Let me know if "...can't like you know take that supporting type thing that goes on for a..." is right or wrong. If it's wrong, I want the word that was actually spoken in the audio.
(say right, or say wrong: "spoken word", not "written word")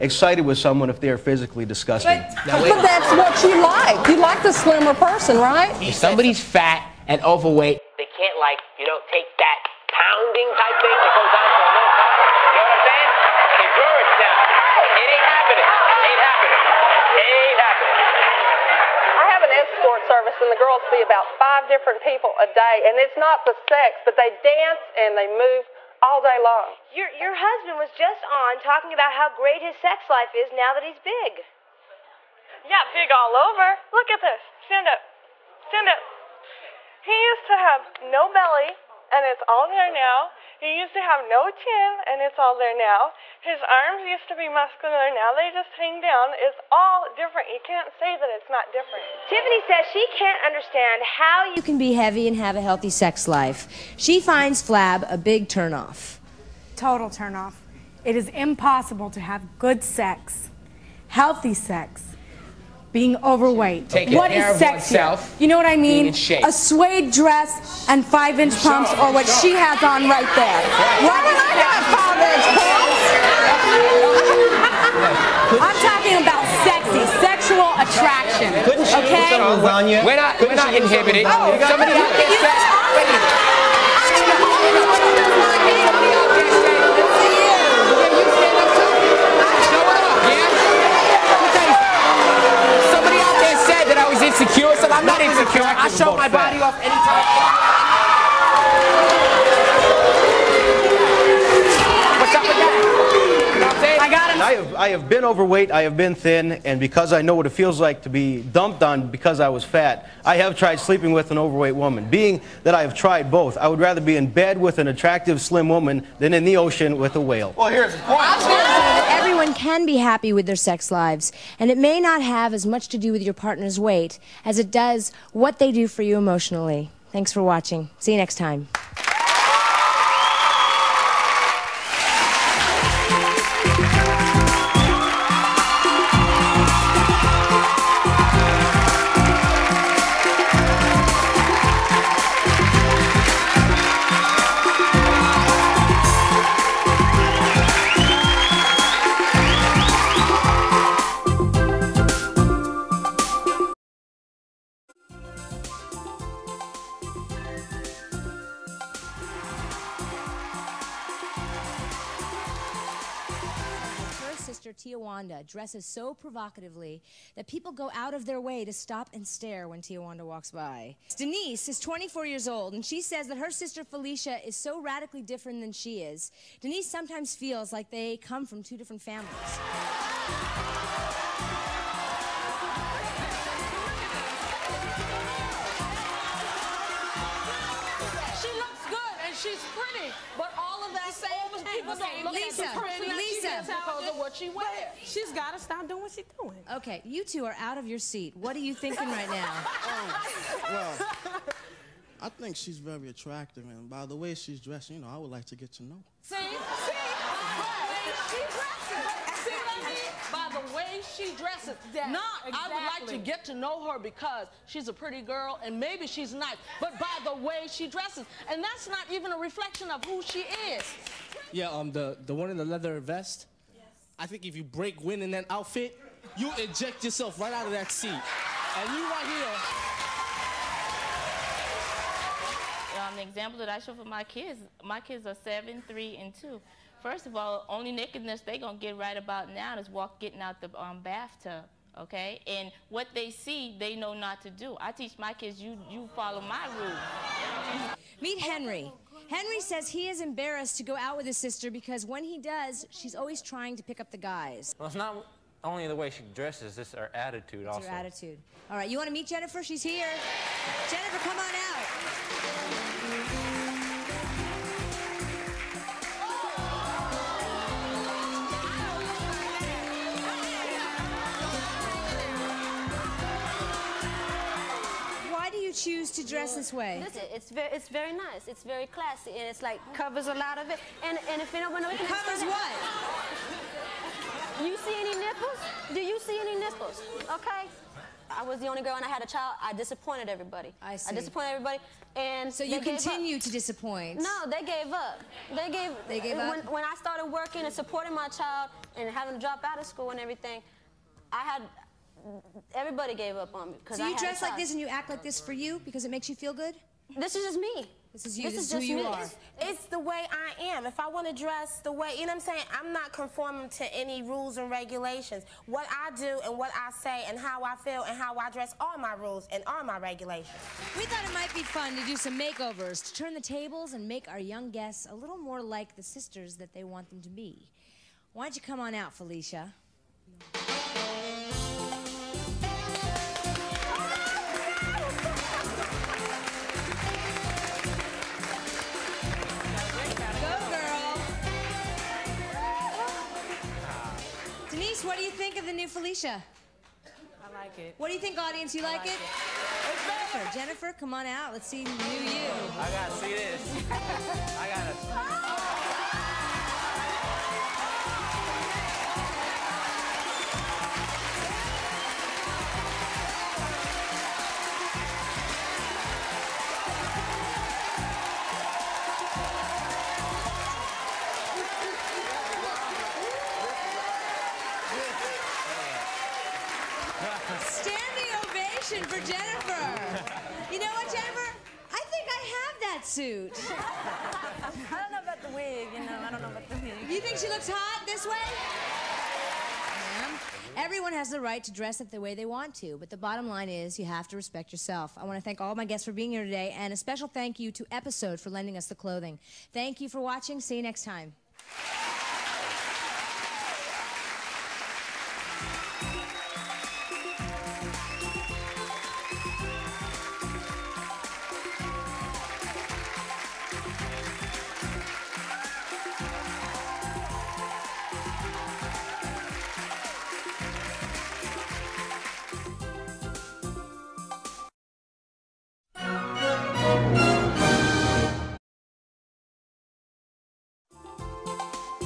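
wrong: "pounding", not "supporting".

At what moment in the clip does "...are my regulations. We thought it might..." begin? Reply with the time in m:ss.
5:19.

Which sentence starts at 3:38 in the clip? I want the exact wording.
And that's not even a reflection of who she is.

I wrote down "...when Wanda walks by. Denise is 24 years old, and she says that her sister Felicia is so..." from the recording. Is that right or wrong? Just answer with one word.
right.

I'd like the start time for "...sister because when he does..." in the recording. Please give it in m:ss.
4:11.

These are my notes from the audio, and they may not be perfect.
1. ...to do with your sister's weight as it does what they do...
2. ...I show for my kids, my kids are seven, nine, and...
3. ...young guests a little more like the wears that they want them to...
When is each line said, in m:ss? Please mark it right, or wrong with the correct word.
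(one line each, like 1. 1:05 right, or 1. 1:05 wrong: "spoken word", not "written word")
1. 2:02 wrong: "partner", not "sister"
2. 3:53 wrong: "three", not "nine"
3. 5:24 wrong: "sisters", not "wears".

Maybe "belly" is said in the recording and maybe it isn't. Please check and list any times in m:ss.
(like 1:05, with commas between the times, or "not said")
0:38.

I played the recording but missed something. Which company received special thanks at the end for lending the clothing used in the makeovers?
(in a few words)
Episode.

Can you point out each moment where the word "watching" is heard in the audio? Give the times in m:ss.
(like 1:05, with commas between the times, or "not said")
2:07, 6:40.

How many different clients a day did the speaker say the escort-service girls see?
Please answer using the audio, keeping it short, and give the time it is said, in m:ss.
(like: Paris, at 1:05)
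5, at 0:21.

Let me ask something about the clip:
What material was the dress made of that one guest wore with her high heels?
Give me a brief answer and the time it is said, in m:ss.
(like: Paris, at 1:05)
Suede, at 1:06.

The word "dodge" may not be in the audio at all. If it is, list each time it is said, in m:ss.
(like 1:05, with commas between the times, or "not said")
not said.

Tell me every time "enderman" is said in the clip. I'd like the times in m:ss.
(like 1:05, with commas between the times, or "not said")
not said.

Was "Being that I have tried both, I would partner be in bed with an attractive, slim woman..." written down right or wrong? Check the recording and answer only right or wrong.
wrong.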